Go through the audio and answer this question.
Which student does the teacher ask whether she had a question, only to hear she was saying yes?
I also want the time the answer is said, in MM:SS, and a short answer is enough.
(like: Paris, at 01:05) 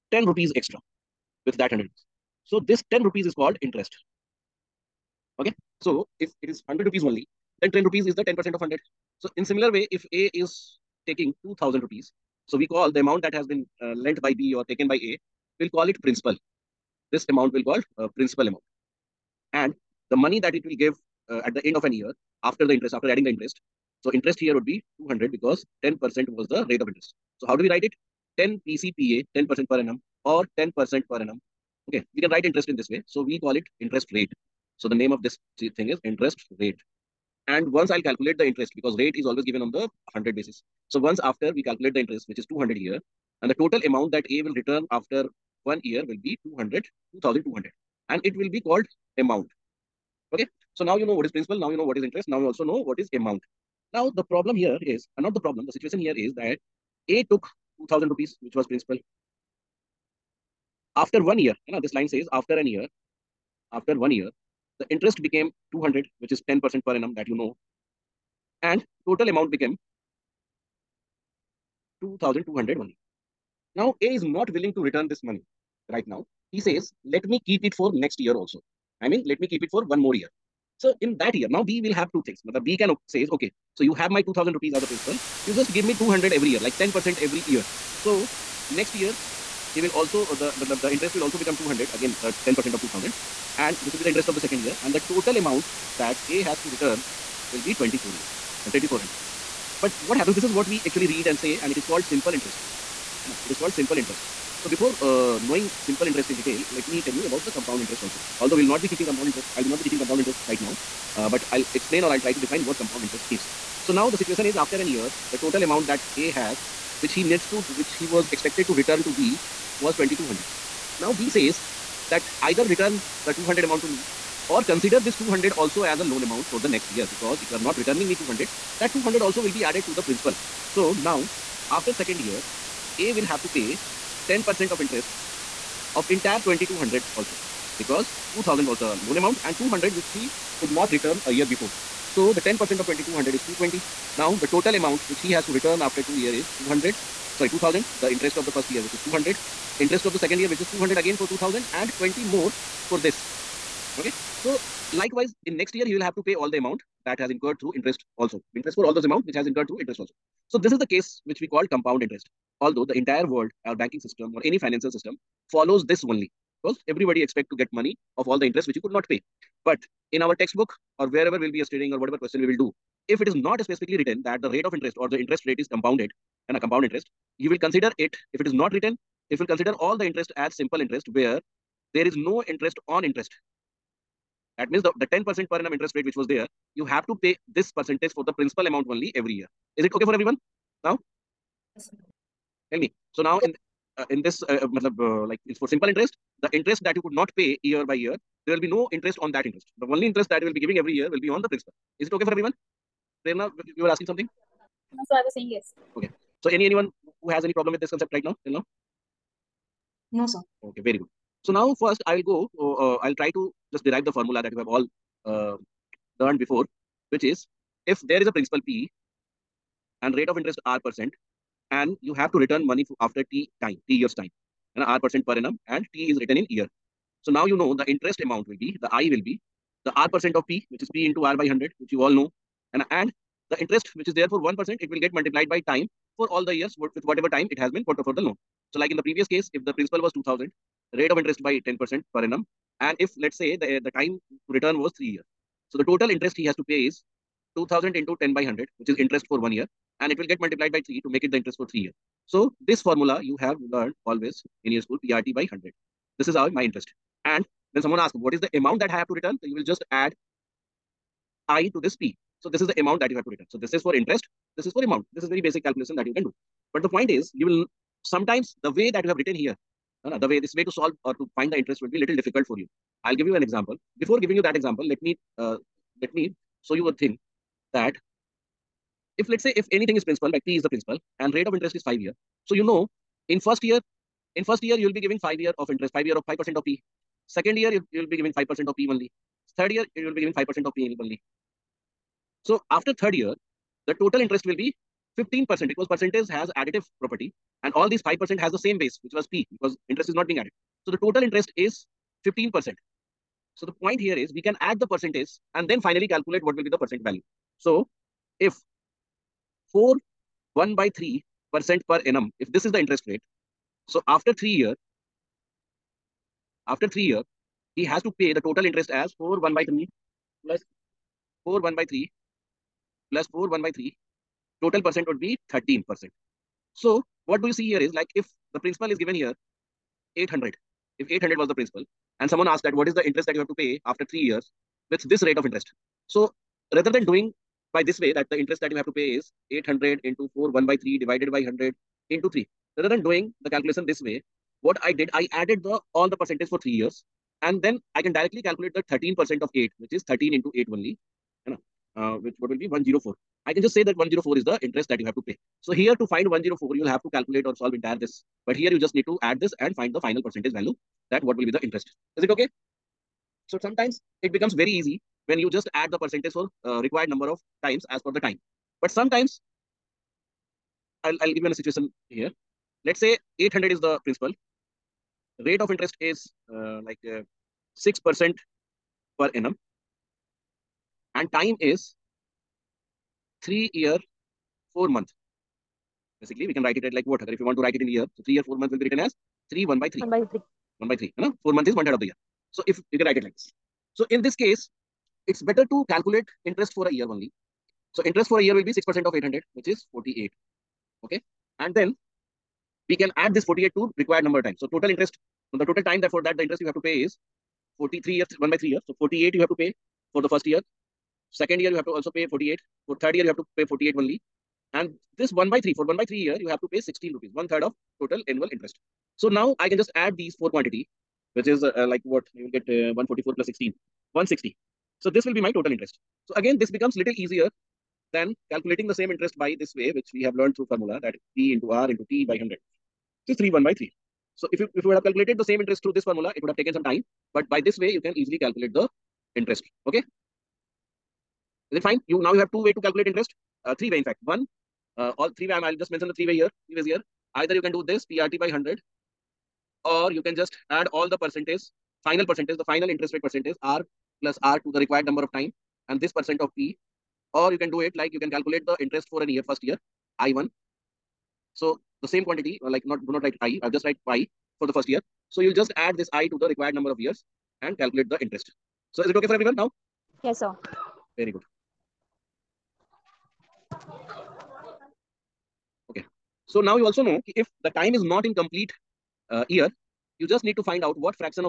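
Prerna, at 03:23.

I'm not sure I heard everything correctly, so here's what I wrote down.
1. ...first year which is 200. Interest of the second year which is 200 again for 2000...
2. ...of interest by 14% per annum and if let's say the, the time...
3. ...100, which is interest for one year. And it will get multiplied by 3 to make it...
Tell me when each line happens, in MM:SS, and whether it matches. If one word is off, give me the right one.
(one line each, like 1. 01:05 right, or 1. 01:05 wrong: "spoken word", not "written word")
1. 02:28 right
2. 04:01 wrong: "10", not "14"
3. 04:08 right.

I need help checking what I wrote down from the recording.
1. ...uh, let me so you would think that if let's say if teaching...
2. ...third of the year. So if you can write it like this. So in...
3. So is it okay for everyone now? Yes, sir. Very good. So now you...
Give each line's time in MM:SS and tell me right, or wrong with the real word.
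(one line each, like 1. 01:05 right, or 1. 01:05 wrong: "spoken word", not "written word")
1. 04:35 wrong: "anything", not "teaching"
2. 06:31 right
3. 07:48 right.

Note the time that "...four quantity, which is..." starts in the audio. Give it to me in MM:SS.
07:00.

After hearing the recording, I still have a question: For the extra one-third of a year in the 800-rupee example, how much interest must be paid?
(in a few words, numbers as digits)
16 rupees.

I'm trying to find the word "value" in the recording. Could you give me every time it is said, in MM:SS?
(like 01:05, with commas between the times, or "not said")
05:07, 06:00.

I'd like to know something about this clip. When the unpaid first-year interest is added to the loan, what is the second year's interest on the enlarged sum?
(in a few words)
220.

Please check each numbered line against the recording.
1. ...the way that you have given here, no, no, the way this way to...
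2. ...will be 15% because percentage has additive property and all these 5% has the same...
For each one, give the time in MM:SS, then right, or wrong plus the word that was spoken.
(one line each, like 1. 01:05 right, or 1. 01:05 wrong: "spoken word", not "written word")
1. 04:28 wrong: "written", not "given"
2. 04:54 right.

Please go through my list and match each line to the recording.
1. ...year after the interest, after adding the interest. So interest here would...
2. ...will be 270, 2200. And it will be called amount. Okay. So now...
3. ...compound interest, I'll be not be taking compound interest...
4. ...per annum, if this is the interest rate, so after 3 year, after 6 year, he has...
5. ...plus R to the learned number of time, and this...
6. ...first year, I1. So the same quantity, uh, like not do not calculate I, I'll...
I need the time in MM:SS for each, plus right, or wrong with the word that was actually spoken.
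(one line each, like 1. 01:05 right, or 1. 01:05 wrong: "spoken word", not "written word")
1. 00:21 right
2. 00:46 wrong: "200", not "270"
3. 01:49 wrong: "teaching", not "taking"
4. 05:11 wrong: "3", not "6"
5. 07:34 wrong: "required", not "learned"
6. 07:39 wrong: "write", not "calculate".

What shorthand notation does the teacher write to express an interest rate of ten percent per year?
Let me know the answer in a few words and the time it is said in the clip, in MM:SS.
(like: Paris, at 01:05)
10 PCPA, at 00:28.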